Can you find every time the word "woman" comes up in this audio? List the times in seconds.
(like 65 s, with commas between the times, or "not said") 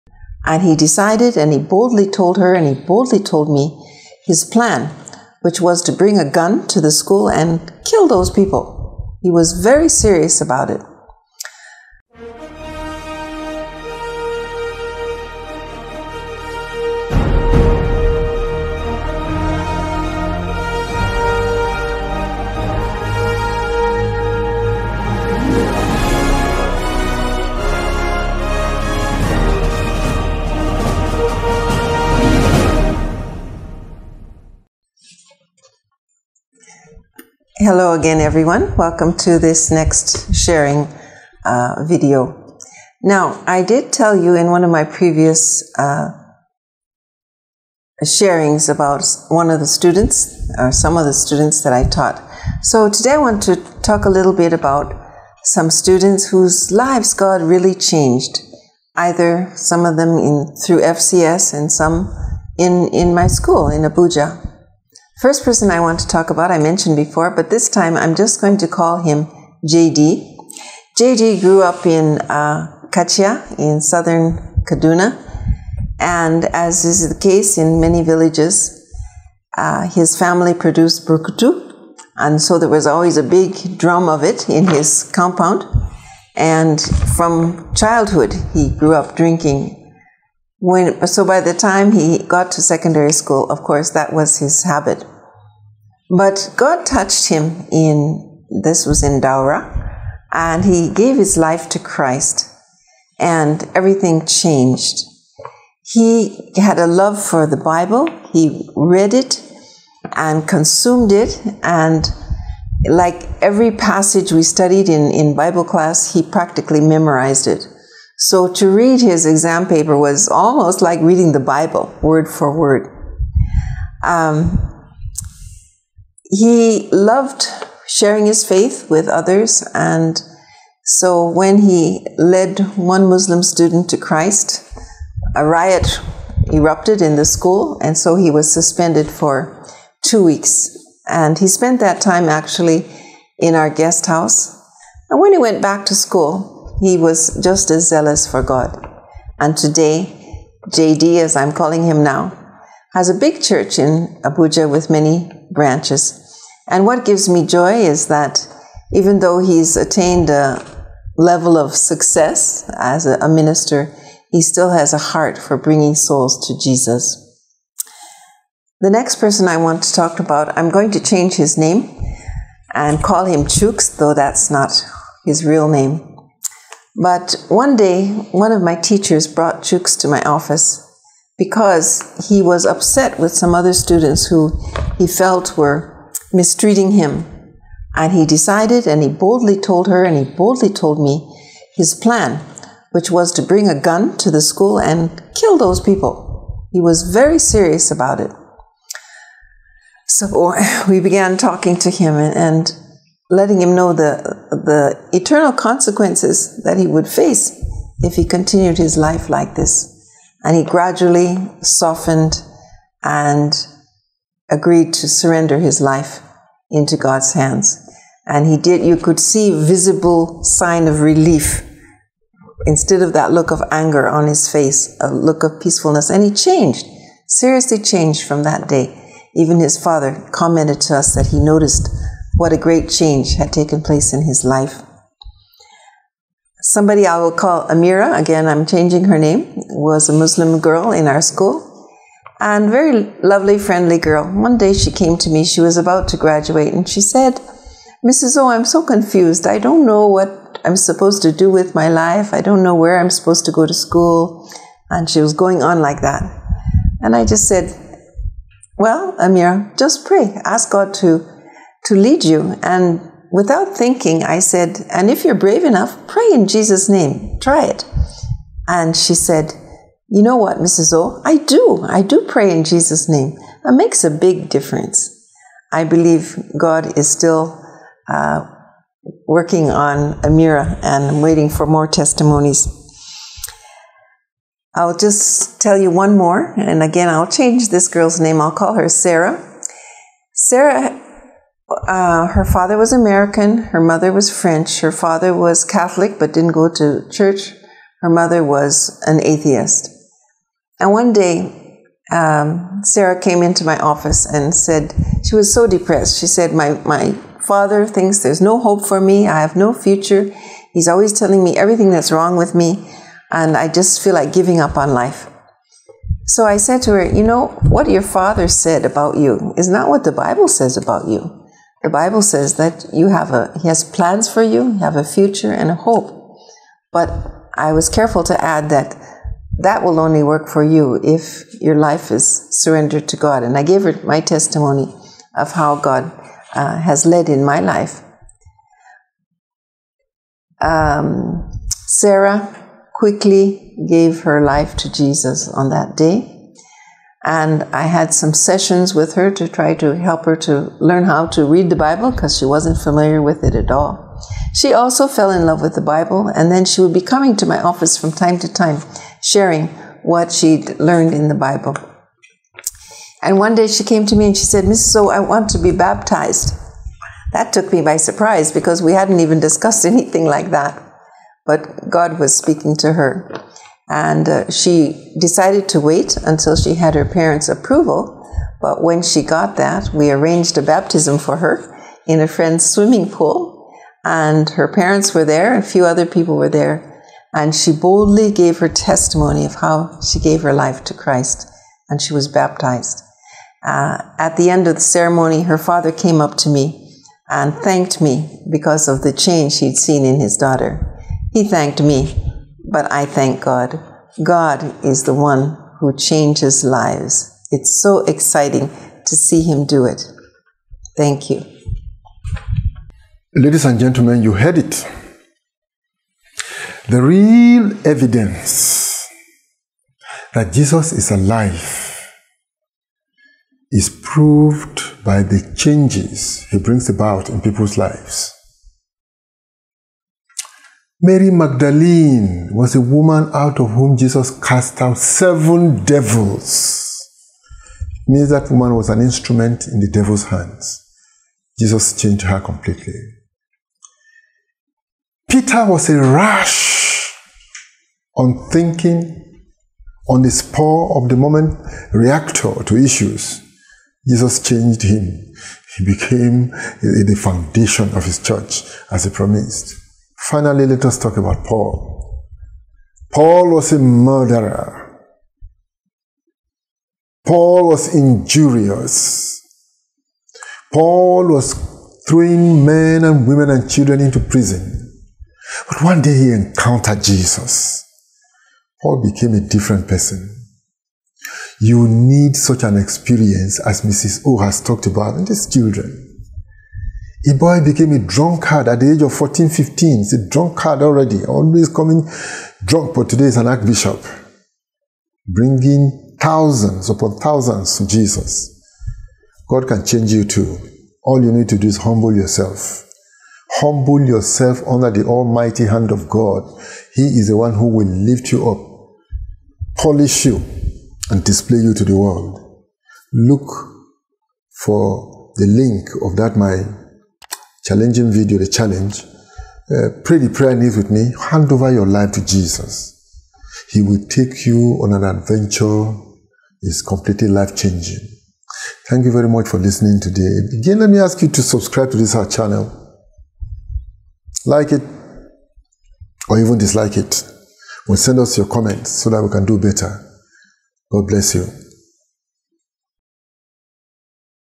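432 s, 438 s.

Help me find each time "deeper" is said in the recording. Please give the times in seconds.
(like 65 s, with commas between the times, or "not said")
not said.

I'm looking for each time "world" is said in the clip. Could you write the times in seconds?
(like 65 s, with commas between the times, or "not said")
511 s.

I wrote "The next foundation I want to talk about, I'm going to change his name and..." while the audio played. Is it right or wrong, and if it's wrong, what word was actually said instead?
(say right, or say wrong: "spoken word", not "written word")
wrong: "person", not "foundation".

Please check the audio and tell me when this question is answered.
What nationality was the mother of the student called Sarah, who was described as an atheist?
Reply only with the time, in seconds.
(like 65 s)
294 s.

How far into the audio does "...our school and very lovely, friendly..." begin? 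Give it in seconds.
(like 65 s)
241 s.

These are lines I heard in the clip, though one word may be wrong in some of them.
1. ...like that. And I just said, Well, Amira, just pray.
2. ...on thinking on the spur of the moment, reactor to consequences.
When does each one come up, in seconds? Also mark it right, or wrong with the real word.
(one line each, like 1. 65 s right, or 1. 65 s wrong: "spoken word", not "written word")
1. 255 s right
2. 448 s wrong: "issues", not "consequences".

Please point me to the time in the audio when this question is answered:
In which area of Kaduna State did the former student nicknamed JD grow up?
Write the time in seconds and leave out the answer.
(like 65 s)
72 s.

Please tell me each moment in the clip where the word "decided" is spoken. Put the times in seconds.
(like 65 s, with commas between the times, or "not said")
0 s, 188 s, 375 s.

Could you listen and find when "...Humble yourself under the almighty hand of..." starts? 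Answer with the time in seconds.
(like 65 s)
503 s.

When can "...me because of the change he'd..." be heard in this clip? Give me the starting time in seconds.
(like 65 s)
398 s.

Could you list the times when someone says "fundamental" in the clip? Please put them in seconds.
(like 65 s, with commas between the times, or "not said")
not said.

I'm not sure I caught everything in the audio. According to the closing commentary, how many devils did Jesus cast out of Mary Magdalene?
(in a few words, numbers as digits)
7.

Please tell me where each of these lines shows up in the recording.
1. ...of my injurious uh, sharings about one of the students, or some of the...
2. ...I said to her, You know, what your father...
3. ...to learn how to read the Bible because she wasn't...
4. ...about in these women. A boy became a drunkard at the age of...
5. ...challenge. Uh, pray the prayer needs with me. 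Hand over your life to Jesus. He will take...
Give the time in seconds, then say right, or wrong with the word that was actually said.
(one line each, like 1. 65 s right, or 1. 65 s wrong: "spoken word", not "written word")
1. 44 s wrong: "previous", not "injurious"
2. 316 s right
3. 350 s right
4. 484 s wrong: "children", not "women"
5. 518 s right.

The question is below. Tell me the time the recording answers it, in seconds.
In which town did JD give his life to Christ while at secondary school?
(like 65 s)
99 s.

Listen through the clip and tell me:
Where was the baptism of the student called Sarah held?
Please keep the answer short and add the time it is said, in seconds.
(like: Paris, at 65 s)
A friend's swimming pool, at 382 s.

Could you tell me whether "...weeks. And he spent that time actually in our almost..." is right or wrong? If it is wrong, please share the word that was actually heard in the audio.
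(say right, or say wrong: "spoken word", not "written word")
wrong: "guest", not "almost".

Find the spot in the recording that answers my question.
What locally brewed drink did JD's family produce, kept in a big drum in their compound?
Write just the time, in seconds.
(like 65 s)
81 s.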